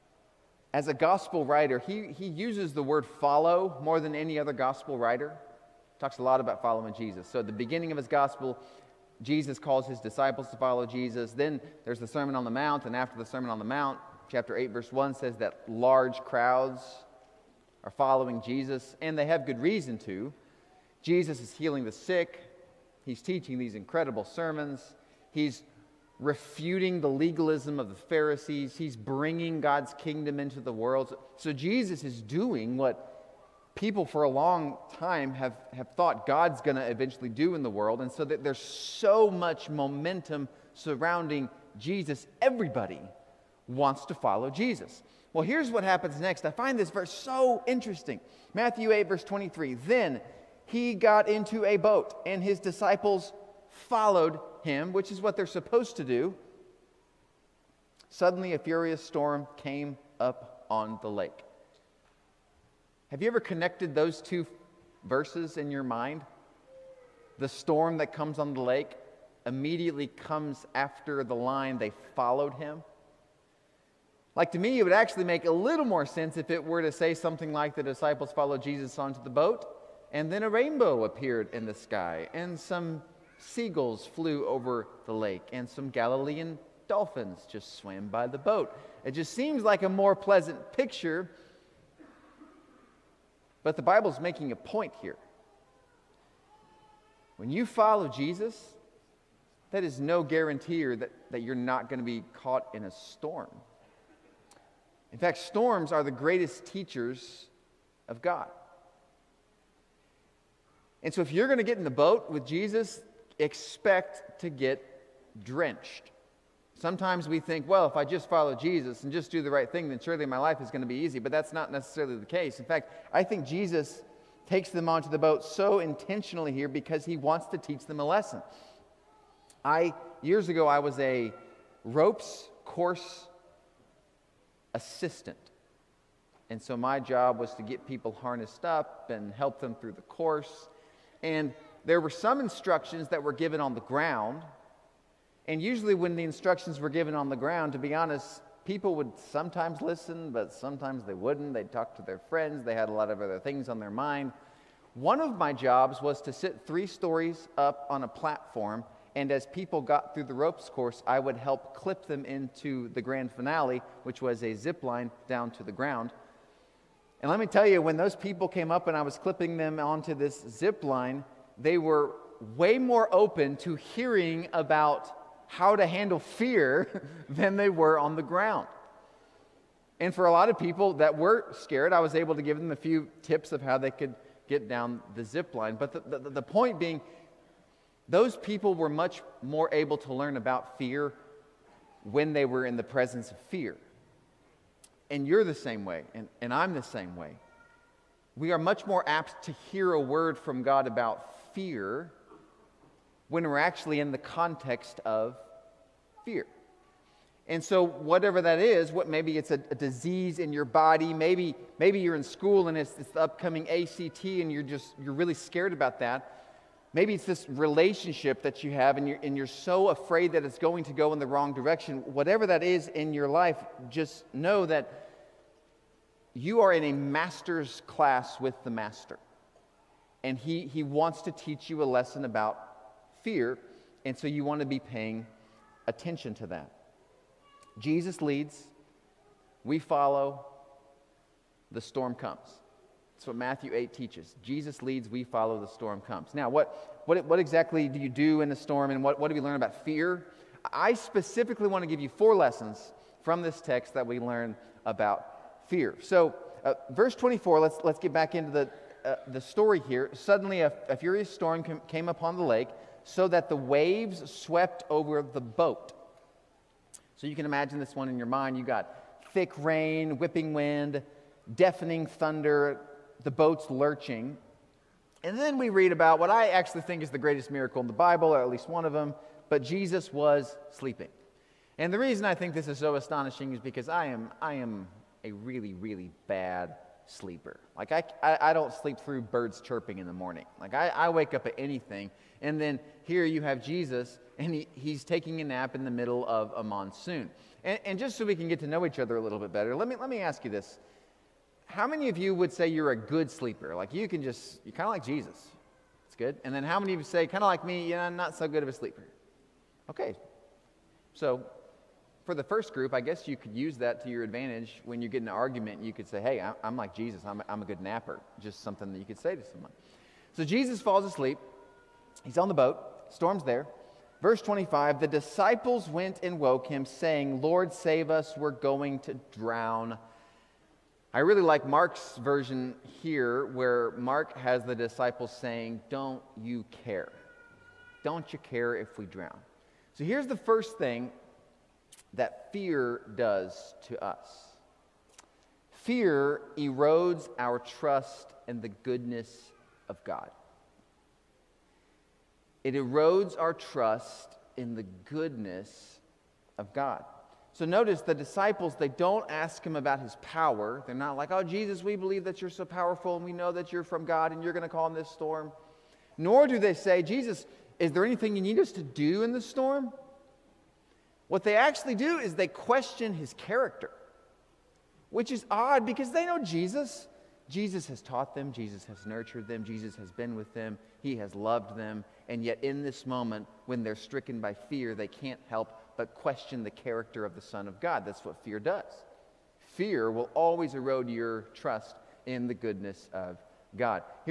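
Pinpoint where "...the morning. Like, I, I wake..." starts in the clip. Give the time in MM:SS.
04:50.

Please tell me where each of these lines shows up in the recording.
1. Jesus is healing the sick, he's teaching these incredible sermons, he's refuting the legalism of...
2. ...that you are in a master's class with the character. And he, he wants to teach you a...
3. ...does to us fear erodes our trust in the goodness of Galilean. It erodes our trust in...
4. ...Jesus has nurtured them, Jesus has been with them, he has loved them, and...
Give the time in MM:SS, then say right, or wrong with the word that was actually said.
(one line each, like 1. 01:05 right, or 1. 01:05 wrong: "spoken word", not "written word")
1. 00:21 right
2. 03:44 wrong: "master", not "character"
3. 05:43 wrong: "God", not "Galilean"
4. 06:18 right.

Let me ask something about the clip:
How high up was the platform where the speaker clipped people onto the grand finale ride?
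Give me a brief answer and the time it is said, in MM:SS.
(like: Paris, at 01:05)
Three stories, at 02:36.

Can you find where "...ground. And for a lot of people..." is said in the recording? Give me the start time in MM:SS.
02:58.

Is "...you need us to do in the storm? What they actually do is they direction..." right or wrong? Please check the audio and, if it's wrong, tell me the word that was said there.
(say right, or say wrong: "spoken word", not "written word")
wrong: "question", not "direction".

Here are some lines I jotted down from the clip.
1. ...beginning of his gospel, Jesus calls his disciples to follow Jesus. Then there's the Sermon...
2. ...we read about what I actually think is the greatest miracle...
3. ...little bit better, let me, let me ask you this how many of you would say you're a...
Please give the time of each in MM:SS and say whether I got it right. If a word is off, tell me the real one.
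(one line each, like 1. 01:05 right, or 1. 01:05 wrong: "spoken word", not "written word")
1. 00:07 right
2. 04:35 right
3. 04:59 right.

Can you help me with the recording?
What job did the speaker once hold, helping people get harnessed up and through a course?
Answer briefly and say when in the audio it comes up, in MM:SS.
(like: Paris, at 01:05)
Ropes course assistant, at 02:11.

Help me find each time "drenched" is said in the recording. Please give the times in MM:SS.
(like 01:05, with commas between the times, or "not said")
01:55.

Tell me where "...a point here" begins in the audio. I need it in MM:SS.
01:34.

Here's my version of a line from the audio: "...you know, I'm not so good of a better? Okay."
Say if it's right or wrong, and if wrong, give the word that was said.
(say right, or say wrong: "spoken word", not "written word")
wrong: "sleeper", not "better".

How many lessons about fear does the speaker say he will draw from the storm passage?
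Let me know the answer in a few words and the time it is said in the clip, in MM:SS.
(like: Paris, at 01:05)
4, at 04:12.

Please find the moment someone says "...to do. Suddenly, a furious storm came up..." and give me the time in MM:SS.
00:55.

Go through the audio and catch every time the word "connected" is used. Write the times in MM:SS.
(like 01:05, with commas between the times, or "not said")
01:03.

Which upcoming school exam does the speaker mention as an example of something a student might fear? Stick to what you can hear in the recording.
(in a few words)
ACT.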